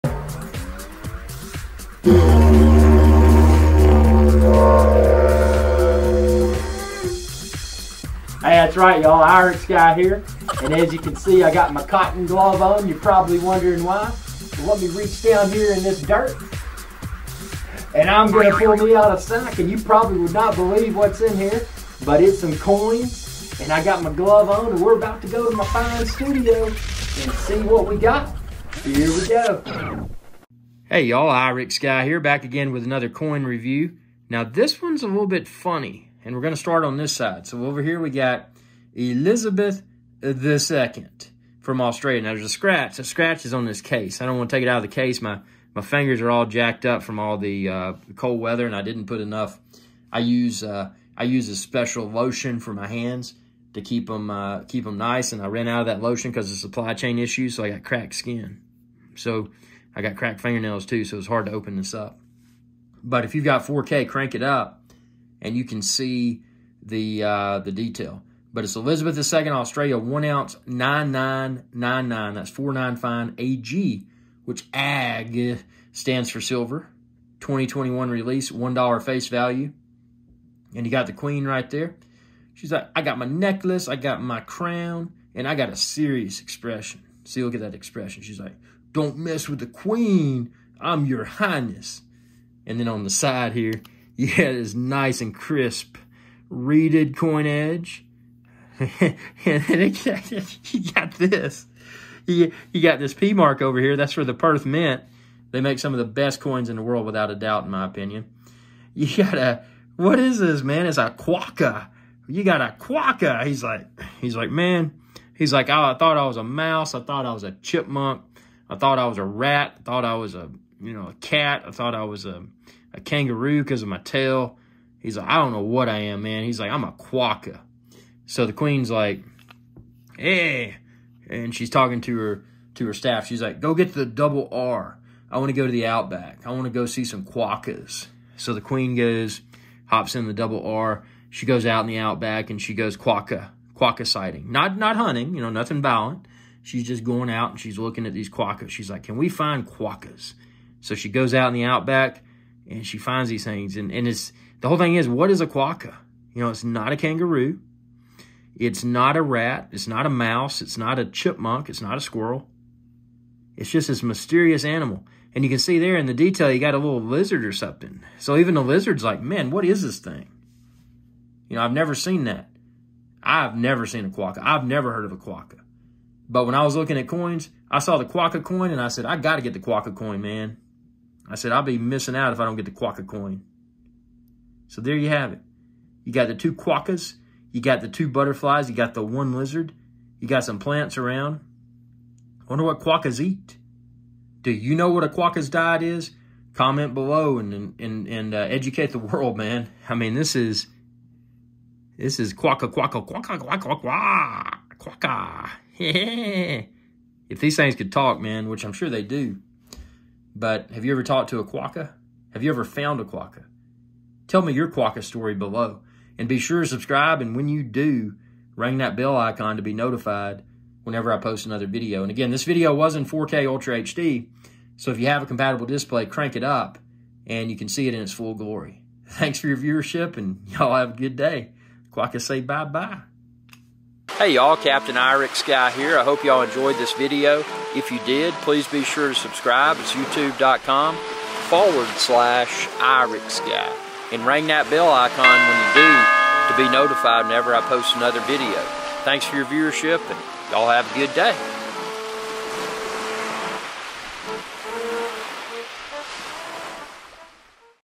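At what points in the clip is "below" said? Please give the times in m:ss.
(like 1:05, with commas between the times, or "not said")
3:16, 3:35.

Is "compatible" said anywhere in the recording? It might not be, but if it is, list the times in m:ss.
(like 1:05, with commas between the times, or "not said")
3:45.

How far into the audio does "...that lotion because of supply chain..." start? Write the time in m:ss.
0:55.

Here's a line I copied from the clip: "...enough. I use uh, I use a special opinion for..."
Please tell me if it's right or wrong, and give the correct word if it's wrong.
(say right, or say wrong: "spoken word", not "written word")
wrong: "lotion", not "opinion".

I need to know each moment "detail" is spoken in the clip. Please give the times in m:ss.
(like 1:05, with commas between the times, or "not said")
1:07, 2:46.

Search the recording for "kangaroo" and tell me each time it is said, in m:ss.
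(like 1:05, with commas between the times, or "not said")
2:03, 2:36.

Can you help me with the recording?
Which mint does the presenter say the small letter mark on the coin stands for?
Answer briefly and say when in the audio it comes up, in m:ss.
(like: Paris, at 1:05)
Perth Mint, at 1:44.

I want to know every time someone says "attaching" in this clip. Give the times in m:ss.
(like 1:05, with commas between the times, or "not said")
not said.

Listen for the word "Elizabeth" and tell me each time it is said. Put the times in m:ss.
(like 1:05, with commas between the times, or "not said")
0:38, 1:08.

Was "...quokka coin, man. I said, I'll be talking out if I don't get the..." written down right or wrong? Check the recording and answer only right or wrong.
wrong.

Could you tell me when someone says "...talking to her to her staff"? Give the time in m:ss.
2:11.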